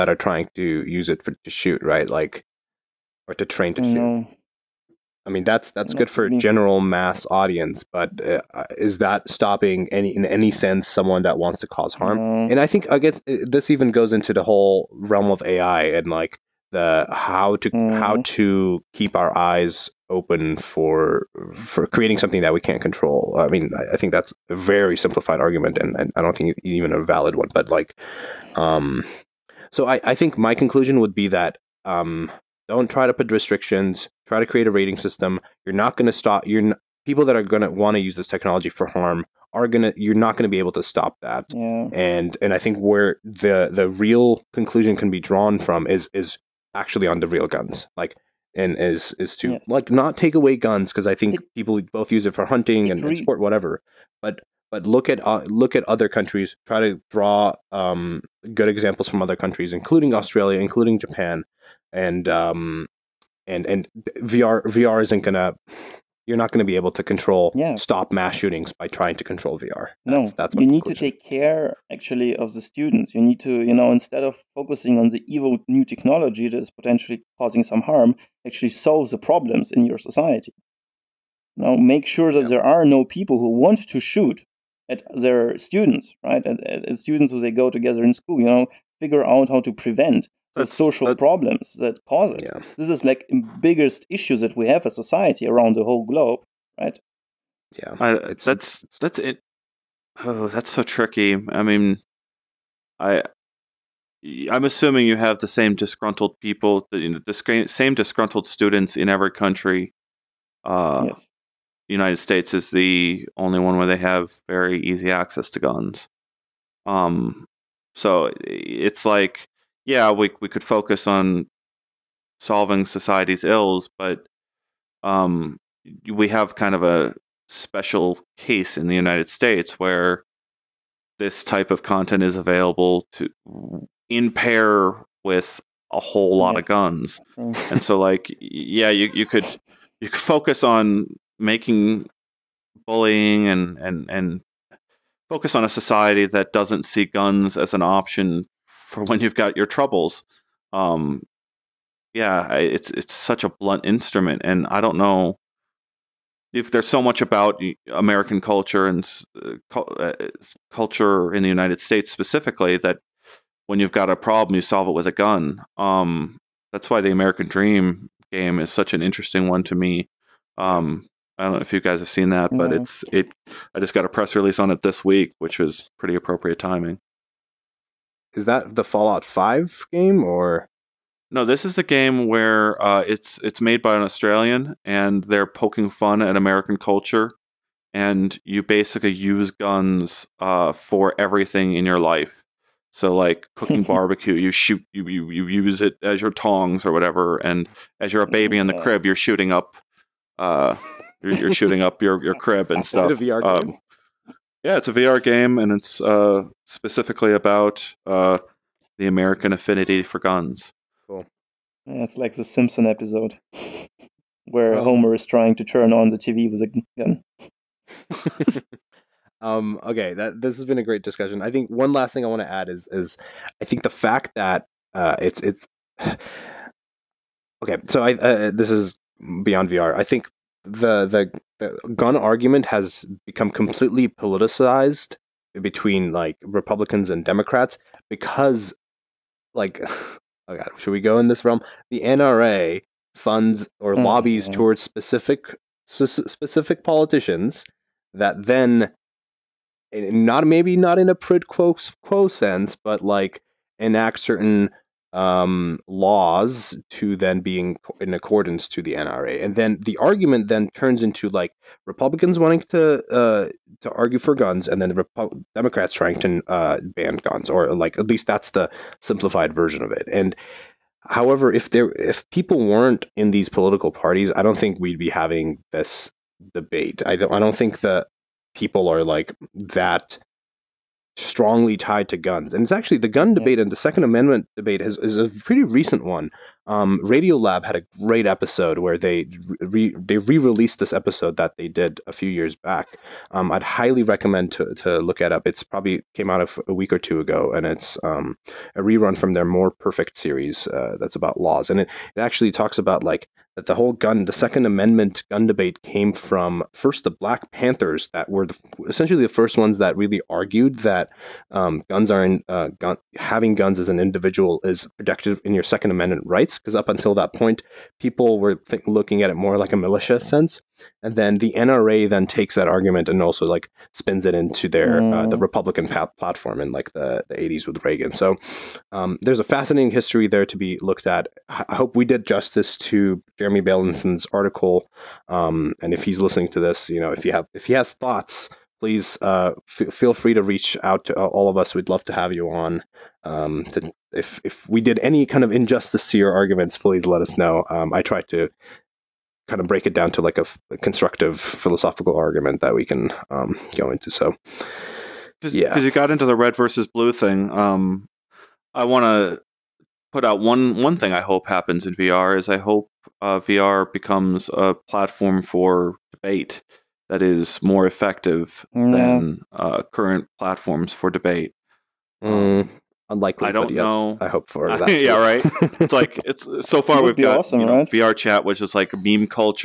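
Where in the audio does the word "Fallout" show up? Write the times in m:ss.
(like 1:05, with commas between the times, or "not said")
2:58.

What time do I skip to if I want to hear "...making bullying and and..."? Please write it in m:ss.
2:21.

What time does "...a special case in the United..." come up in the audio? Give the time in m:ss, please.
2:06.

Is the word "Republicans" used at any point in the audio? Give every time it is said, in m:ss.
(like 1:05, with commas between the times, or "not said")
3:56, 4:21, 5:25.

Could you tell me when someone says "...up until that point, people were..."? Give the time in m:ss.
5:16.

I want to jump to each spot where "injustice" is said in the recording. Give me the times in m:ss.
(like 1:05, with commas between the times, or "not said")
5:45.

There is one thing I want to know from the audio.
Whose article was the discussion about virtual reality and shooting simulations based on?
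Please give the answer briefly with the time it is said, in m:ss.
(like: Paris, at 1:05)
Jeremy Bailenson, at 5:33.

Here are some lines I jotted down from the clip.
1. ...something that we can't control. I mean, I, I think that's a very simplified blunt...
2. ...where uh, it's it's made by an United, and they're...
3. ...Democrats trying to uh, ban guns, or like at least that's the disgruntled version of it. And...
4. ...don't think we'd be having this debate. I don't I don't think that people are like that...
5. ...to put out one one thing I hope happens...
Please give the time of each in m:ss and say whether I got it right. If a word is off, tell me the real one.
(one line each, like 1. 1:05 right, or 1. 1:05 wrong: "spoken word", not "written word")
1. 0:22 wrong: "argument", not "blunt"
2. 3:02 wrong: "Australian", not "United"
3. 4:25 wrong: "simplified", not "disgruntled"
4. 4:34 right
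5. 5:59 right.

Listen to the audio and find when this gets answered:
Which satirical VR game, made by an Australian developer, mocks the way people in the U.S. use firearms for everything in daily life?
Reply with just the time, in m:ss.
2:47.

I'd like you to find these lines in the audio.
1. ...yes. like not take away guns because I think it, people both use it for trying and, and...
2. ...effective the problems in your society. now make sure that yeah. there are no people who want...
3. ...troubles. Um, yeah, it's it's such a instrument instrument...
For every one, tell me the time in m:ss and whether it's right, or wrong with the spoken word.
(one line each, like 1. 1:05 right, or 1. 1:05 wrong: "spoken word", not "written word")
1. 0:49 wrong: "hunting", not "trying"
2. 1:18 wrong: "solve", not "effective"
3. 2:29 wrong: "blunt", not "instrument".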